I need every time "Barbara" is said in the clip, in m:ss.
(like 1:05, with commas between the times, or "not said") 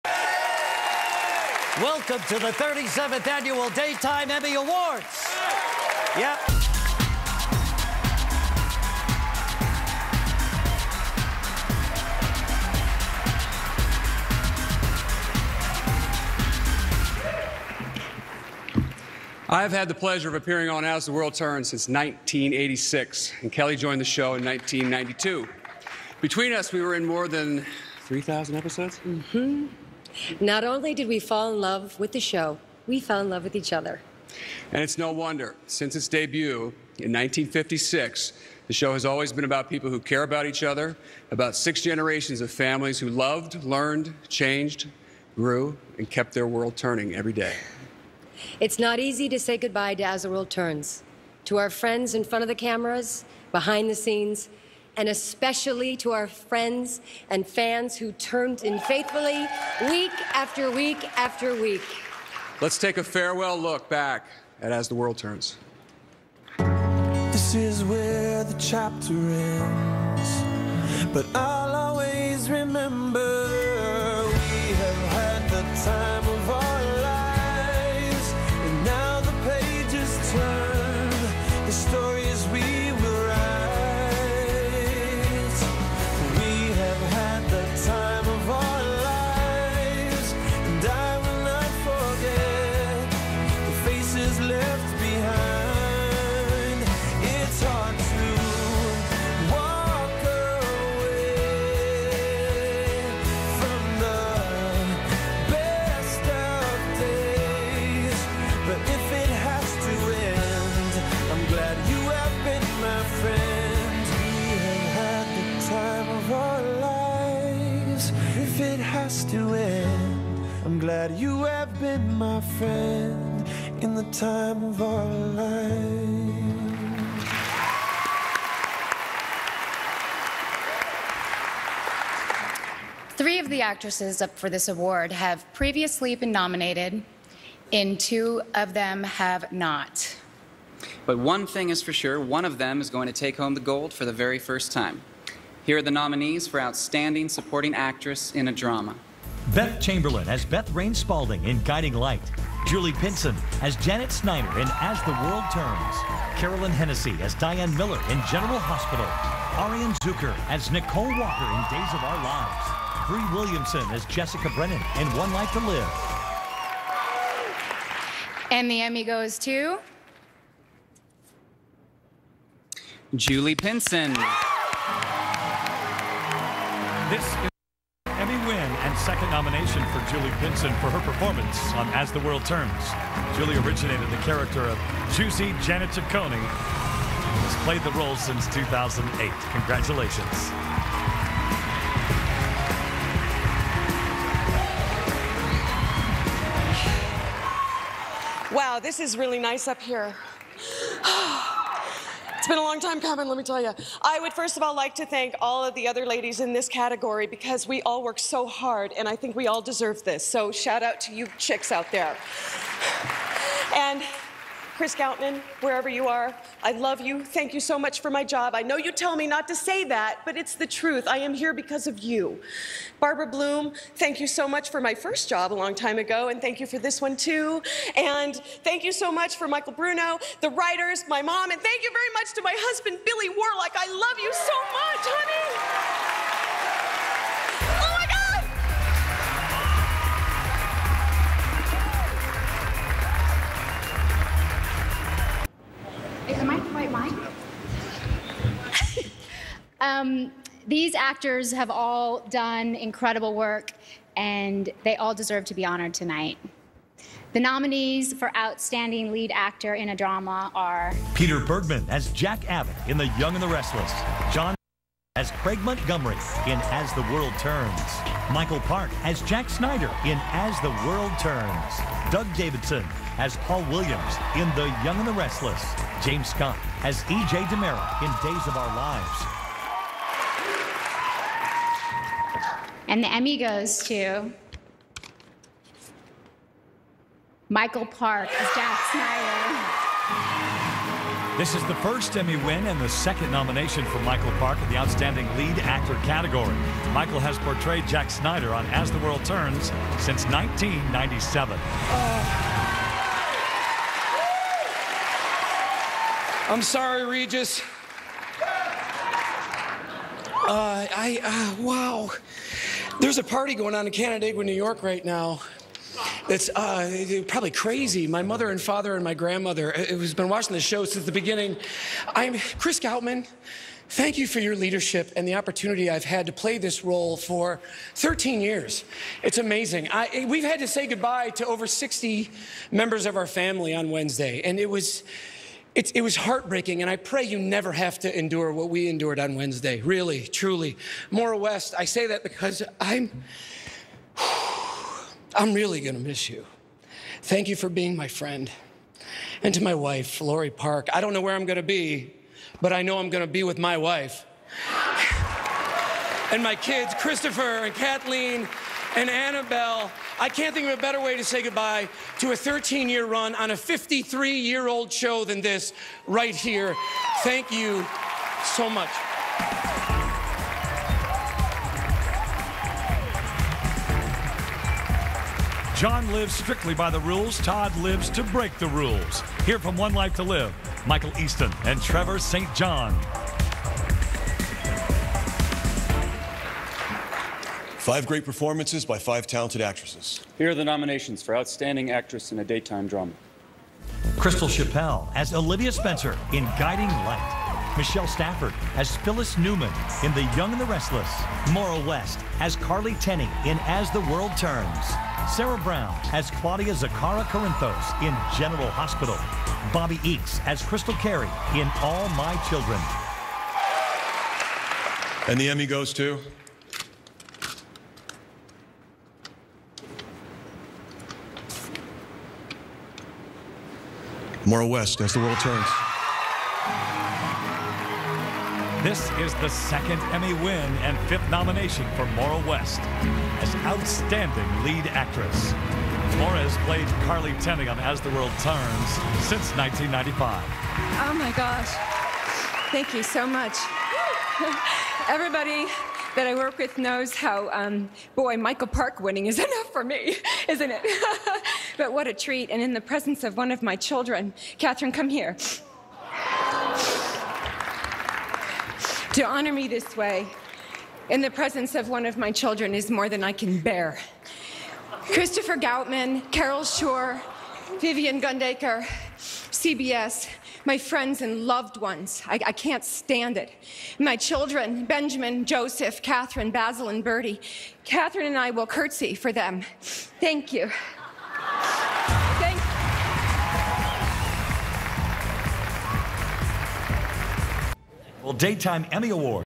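3:42.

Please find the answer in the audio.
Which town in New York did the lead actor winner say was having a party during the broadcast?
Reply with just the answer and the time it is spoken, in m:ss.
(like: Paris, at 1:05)
Canandaigua, at 5:13.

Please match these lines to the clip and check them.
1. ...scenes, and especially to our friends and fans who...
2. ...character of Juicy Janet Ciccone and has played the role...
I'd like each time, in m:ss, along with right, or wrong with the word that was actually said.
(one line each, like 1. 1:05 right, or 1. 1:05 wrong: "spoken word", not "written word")
1. 0:53 right
2. 3:04 right.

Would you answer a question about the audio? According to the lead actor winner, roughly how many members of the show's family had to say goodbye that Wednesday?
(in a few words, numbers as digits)
over 60.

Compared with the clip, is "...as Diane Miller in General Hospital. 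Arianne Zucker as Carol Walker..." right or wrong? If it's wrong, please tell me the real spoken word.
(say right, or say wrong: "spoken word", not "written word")
wrong: "Nicole", not "Carol".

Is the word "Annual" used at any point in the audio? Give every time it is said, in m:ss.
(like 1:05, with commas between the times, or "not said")
0:03.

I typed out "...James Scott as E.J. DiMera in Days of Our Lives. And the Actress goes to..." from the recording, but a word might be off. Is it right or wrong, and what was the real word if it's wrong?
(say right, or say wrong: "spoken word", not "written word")
wrong: "Emmy", not "Actress".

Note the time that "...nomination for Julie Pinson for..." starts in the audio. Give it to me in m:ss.
2:59.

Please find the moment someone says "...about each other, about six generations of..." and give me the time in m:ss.
0:40.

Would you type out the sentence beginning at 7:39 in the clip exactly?
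to honor me this way, in the presence of one of my children, is more than I can bear.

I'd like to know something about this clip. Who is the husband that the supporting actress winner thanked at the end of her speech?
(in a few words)
Billy Warlock.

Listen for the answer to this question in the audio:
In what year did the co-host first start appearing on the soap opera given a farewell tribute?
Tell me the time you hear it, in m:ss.
0:21.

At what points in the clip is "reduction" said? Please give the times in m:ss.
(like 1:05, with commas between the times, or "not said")
not said.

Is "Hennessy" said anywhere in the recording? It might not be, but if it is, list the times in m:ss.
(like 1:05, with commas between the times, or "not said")
2:36.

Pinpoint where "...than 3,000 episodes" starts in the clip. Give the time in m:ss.
0:27.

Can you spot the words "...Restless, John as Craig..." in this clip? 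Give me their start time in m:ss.
4:23.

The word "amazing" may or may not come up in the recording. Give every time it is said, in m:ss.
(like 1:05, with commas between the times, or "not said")
5:29.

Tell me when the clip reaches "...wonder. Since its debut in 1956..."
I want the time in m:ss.
0:35.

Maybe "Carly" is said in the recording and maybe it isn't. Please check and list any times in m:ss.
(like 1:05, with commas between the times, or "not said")
6:42, 7:17.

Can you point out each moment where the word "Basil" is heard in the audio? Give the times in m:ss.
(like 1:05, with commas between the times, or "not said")
7:56.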